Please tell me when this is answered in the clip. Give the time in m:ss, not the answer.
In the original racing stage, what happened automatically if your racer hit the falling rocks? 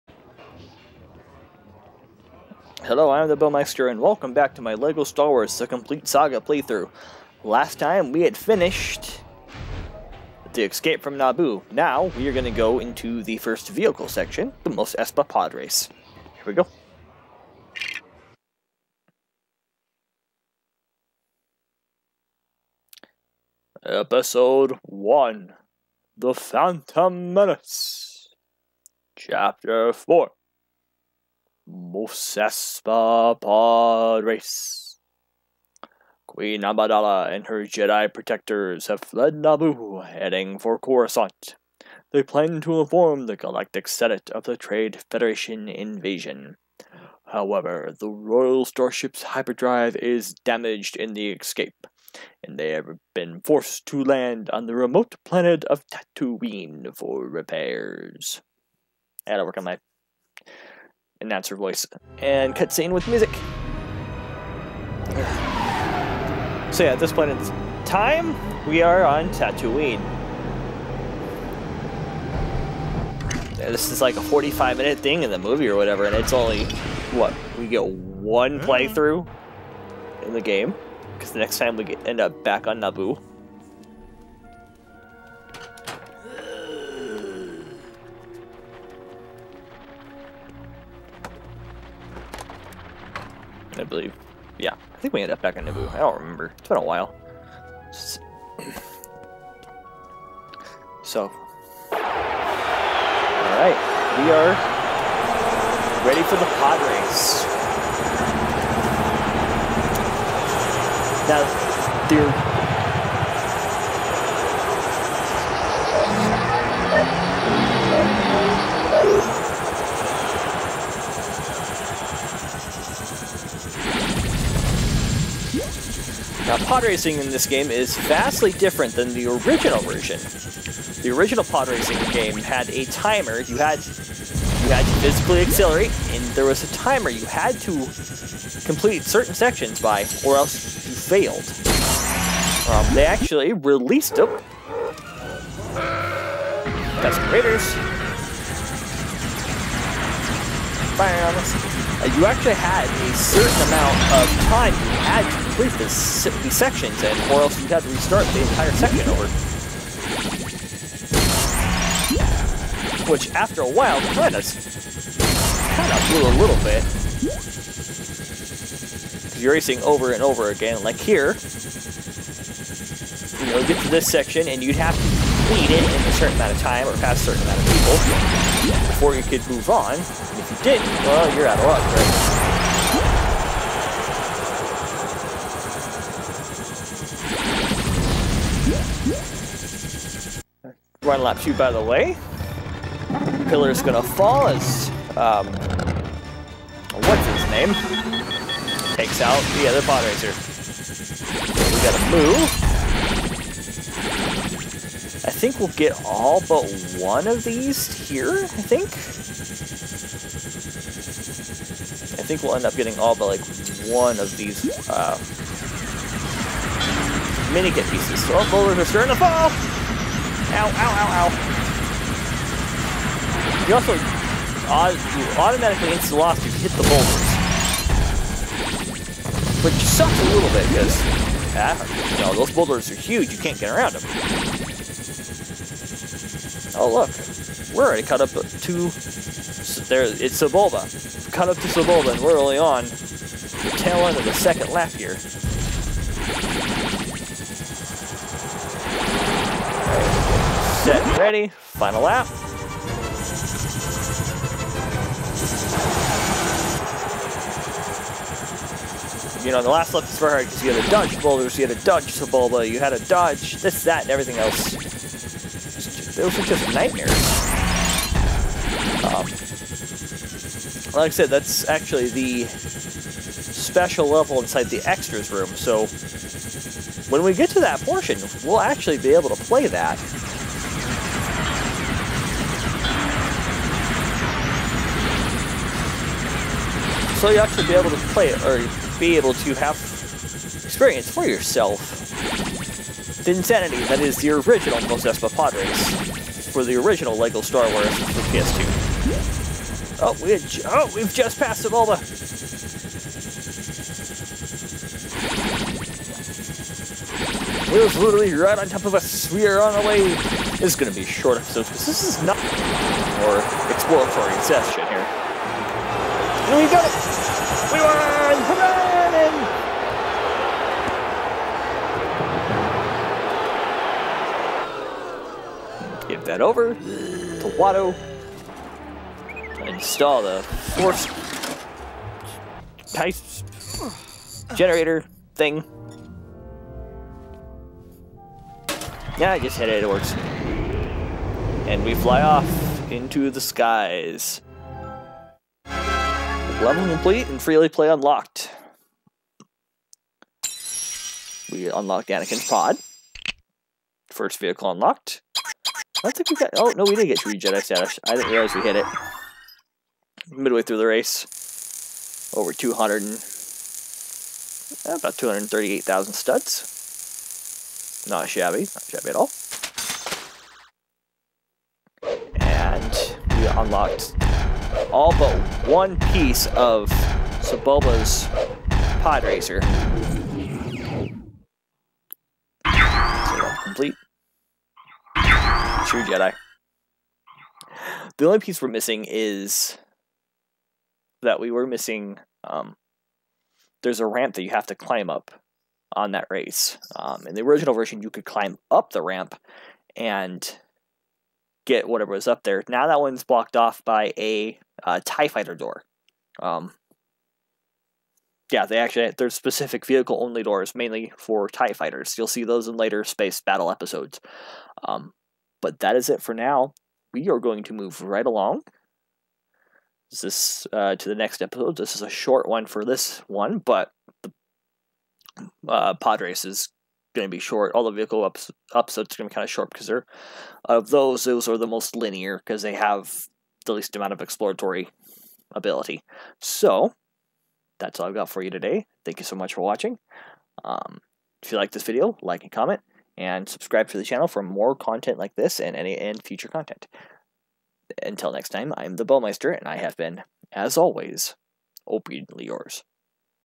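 3:45.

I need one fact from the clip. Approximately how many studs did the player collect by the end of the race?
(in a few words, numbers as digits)
238,000.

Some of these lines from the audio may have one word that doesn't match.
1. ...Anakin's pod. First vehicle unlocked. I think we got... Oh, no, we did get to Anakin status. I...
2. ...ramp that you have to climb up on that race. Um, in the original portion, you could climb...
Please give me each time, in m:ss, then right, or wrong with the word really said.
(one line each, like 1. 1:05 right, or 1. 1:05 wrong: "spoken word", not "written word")
1. 5:52 wrong: "Jedi", not "Anakin"
2. 6:34 wrong: "version", not "portion".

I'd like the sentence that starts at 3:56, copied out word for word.
Oh, look, we're already cut up to, there, it's Sebulba.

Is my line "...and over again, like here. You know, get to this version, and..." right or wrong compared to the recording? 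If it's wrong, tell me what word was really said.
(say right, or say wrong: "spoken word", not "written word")
wrong: "section", not "version".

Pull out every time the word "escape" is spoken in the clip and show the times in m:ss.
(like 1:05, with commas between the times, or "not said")
0:10, 0:51.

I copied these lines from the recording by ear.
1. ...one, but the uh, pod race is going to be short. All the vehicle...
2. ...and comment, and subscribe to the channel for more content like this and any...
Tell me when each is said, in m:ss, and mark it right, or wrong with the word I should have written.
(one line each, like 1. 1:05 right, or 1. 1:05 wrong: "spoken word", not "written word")
1. 7:03 right
2. 7:22 right.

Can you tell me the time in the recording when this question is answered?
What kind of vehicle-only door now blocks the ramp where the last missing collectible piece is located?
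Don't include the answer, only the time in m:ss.
6:45.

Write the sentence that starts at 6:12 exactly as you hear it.
And we unlocked all but one piece of Sebulba's pod racer.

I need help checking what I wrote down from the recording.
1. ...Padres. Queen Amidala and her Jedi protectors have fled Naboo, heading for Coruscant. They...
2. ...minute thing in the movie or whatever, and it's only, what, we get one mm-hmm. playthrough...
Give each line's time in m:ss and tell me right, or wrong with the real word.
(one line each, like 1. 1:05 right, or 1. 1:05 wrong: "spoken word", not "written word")
1. 0:33 right
2. 1:14 right.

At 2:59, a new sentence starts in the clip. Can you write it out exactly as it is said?
And if you didn't, well, you're out of luck, right?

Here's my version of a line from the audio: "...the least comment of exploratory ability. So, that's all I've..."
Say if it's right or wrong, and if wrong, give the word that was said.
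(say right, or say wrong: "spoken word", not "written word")
wrong: "amount", not "comment".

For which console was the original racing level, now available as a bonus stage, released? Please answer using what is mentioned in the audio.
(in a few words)
PS2.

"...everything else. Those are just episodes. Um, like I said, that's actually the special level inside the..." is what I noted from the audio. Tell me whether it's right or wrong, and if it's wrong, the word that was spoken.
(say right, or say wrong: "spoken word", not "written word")
wrong: "nightmares", not "episodes".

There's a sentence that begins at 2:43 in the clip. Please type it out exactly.
Which, after a while, kind of kind of blew a little bit.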